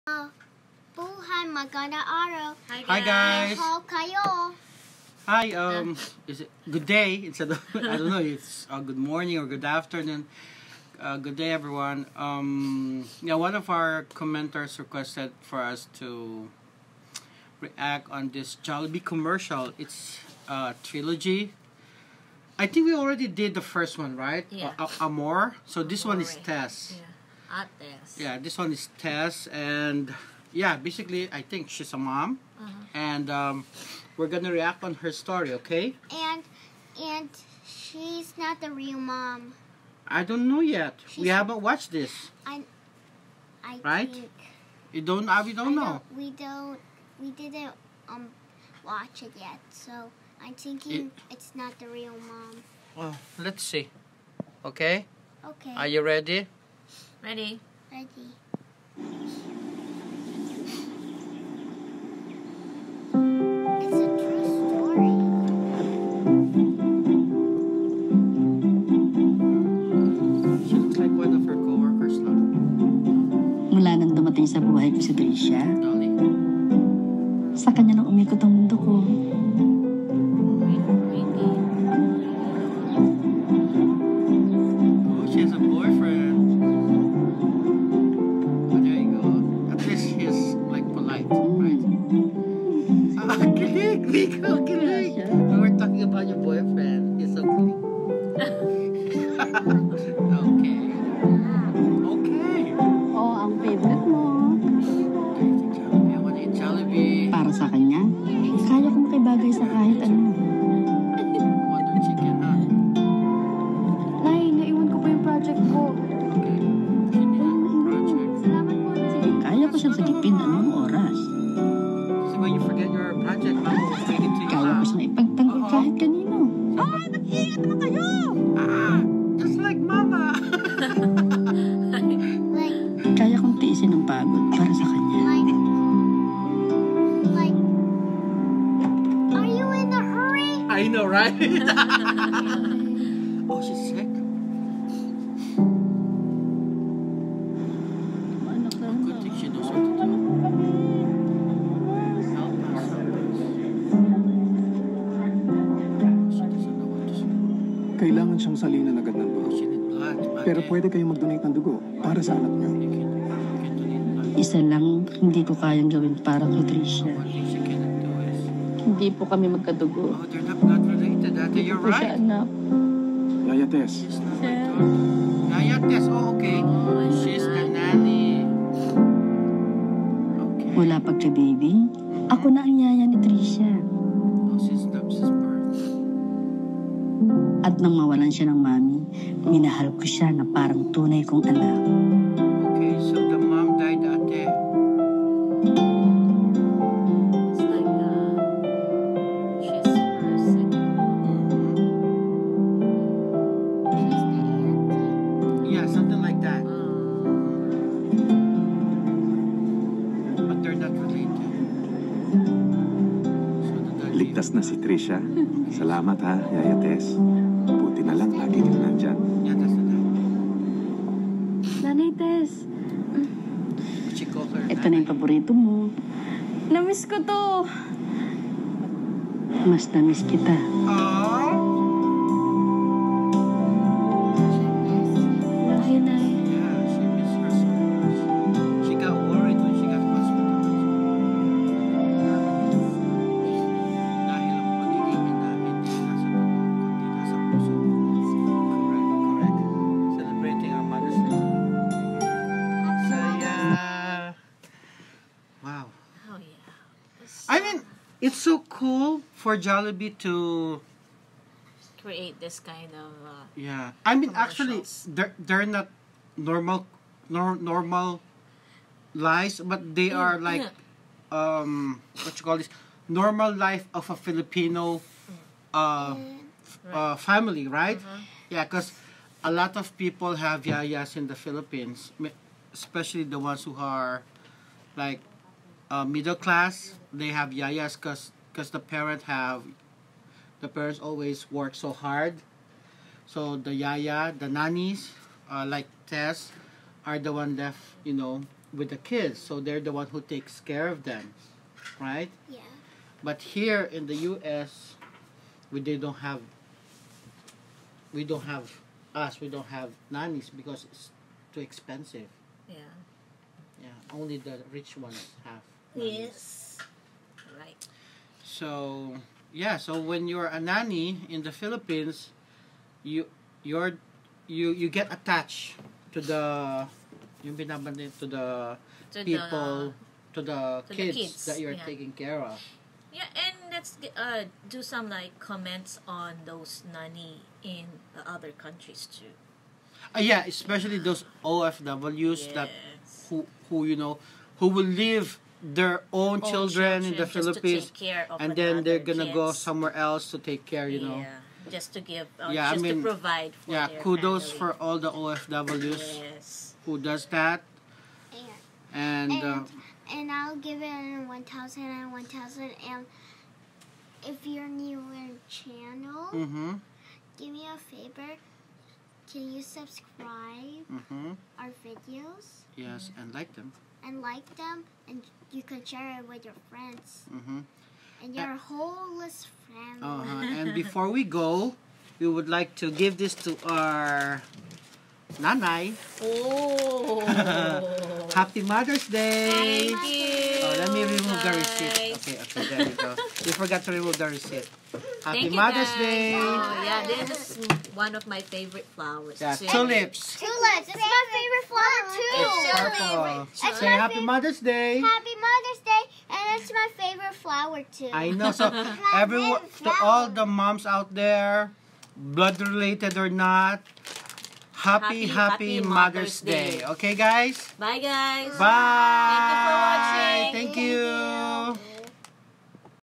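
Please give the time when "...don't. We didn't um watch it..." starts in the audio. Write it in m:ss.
0:46.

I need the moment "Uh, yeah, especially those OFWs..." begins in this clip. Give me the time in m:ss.
5:40.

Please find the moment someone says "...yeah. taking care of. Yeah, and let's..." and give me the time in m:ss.
5:31.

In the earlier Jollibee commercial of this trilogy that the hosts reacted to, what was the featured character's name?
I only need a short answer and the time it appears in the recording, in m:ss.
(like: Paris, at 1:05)
Amor, at 0:24.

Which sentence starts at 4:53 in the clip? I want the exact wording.
So the yaya, the nannies, uh, like Tess, are the one left, you know, with the kids.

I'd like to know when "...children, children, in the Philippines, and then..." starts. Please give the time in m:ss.
5:46.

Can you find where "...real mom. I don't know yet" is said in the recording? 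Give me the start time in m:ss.
0:38.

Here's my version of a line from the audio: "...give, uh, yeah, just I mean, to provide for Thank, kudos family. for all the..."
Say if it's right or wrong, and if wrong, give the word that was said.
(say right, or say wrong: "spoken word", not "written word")
wrong: "Yeah", not "Thank".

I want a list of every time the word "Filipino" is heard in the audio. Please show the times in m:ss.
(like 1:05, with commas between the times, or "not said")
4:34.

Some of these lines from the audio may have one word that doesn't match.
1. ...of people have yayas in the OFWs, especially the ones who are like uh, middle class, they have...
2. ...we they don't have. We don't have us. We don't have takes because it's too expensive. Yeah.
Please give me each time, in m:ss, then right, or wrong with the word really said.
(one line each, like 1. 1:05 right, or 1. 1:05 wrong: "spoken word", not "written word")
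1. 4:39 wrong: "Philippines", not "OFWs"
2. 5:05 wrong: "nannies", not "takes".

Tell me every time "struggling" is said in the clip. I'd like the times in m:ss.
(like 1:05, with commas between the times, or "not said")
not said.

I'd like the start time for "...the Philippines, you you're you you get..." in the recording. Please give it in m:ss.
5:21.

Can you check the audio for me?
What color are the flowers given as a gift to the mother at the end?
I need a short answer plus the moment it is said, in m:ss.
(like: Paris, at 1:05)
Purple, at 6:42.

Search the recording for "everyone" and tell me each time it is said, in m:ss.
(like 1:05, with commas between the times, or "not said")
0:11, 6:49.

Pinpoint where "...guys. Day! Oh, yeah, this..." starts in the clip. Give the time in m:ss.
6:35.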